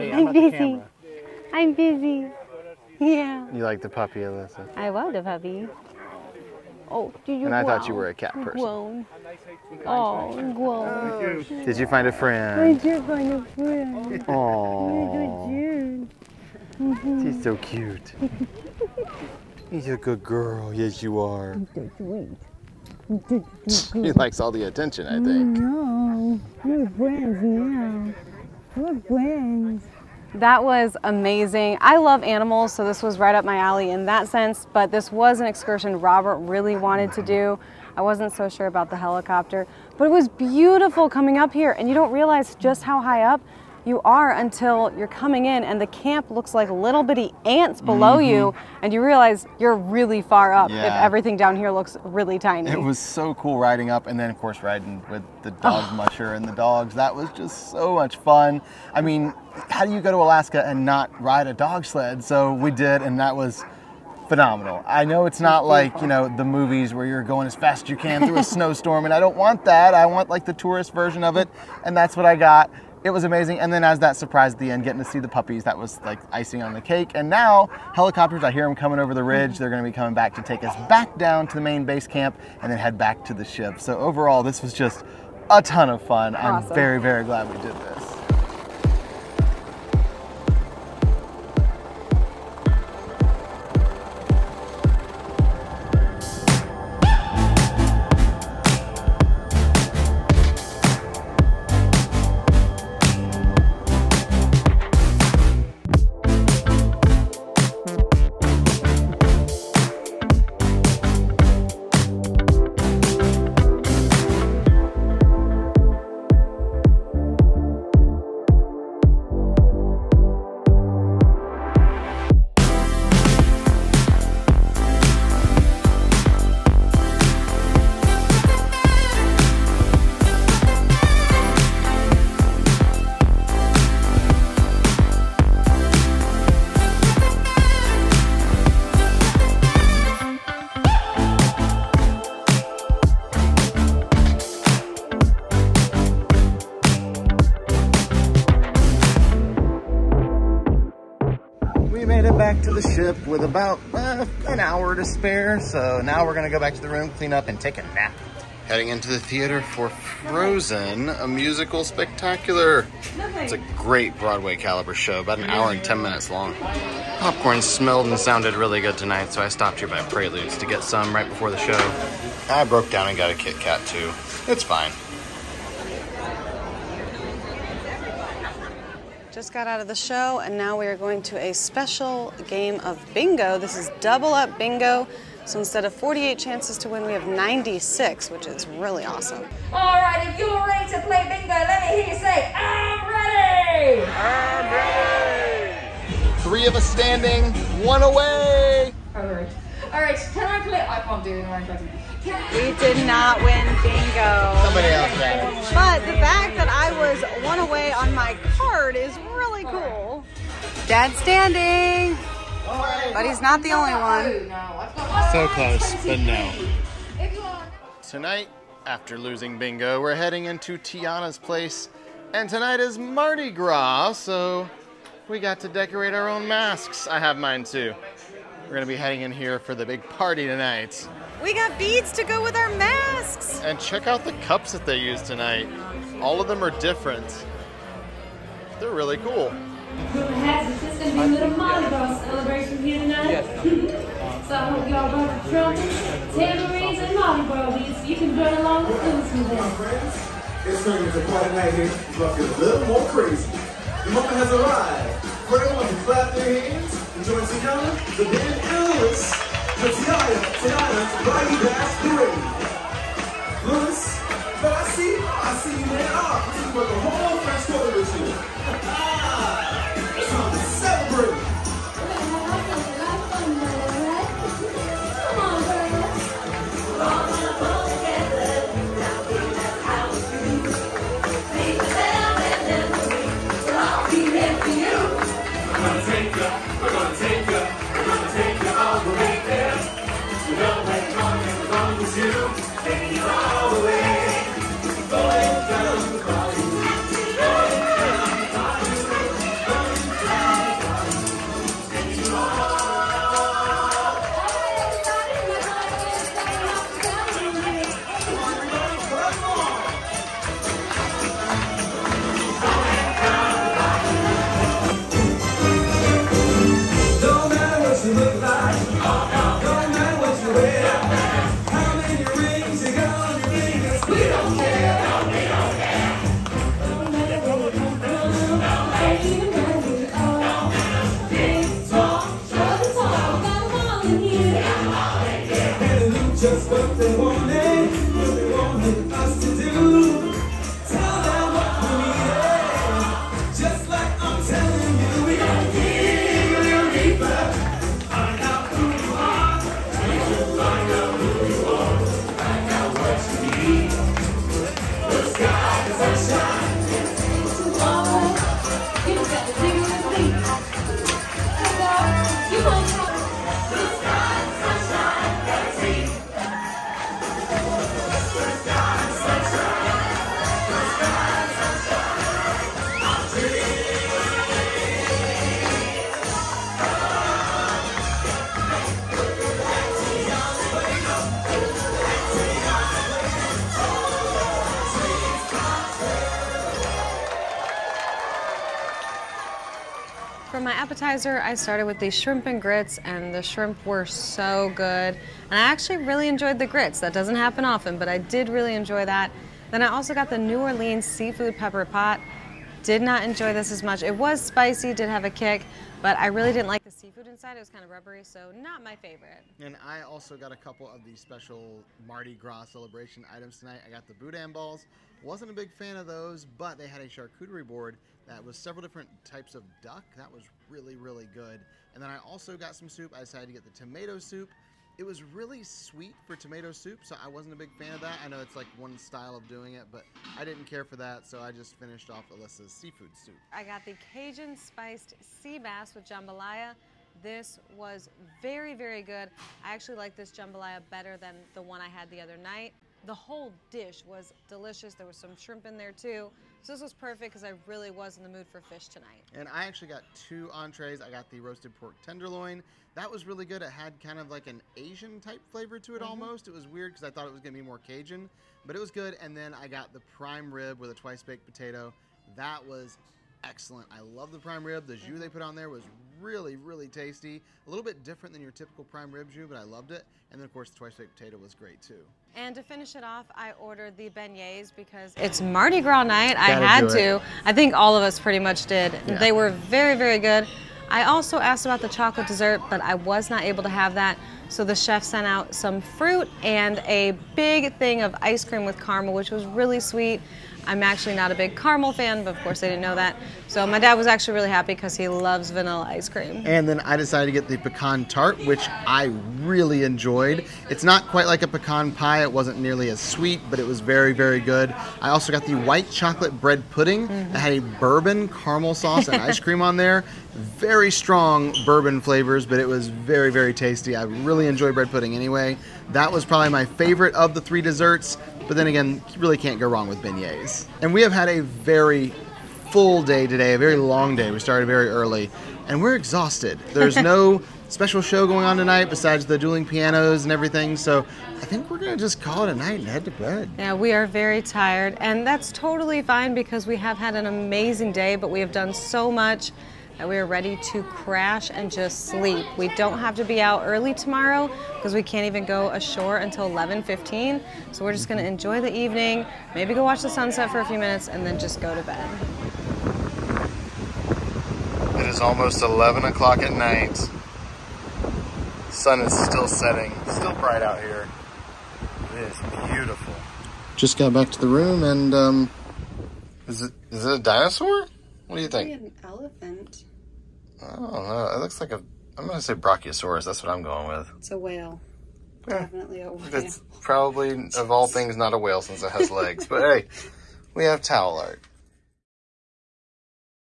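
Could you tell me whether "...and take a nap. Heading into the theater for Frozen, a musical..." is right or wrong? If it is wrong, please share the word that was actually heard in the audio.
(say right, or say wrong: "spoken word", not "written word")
right.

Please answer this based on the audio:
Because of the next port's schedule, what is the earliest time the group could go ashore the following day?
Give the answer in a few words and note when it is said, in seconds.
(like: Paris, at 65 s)
11:15, at 546 s.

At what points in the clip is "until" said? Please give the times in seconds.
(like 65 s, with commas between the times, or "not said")
44 s, 546 s.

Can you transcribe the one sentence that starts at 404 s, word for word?
It was spicy, did have a kick, but I really didn't like the seafood inside.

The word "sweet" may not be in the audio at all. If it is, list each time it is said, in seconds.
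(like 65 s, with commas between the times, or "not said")
23 s, 425 s, 489 s, 502 s.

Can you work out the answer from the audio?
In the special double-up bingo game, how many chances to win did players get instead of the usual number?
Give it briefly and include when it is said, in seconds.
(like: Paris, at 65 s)
96, at 187 s.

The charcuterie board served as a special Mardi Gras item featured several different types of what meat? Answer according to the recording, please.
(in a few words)
Duck.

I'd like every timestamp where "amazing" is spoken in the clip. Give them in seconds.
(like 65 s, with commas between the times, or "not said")
31 s, 73 s, 537 s.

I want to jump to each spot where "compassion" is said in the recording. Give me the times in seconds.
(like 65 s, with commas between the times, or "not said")
not said.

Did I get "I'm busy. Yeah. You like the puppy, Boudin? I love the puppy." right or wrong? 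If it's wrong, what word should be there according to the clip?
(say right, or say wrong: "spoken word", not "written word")
wrong: "Alyssa", not "Boudin".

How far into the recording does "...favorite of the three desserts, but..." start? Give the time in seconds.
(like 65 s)
516 s.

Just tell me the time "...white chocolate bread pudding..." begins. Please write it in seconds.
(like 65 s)
505 s.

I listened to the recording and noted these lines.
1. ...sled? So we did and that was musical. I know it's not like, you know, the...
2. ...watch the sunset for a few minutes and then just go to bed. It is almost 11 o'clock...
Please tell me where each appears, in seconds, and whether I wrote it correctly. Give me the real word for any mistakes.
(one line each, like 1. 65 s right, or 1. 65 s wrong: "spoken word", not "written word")
1. 61 s wrong: "phenomenal", not "musical"
2. 549 s right.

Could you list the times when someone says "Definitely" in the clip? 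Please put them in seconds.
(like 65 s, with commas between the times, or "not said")
575 s.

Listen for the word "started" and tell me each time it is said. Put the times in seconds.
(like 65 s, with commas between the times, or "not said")
391 s, 524 s.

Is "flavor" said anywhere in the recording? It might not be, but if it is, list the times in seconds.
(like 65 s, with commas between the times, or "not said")
455 s, 512 s.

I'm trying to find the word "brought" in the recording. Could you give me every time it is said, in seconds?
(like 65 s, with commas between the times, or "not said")
245 s.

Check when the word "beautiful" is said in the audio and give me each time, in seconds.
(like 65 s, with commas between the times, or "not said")
40 s, 562 s.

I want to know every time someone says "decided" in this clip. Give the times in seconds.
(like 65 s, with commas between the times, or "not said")
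423 s, 496 s.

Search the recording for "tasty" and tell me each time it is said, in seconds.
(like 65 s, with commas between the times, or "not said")
466 s, 513 s.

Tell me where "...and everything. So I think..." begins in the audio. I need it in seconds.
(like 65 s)
530 s.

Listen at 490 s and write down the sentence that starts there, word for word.
I'm actually not a big caramel fan, but of course I didn't know that.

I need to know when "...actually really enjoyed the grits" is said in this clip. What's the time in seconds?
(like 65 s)
395 s.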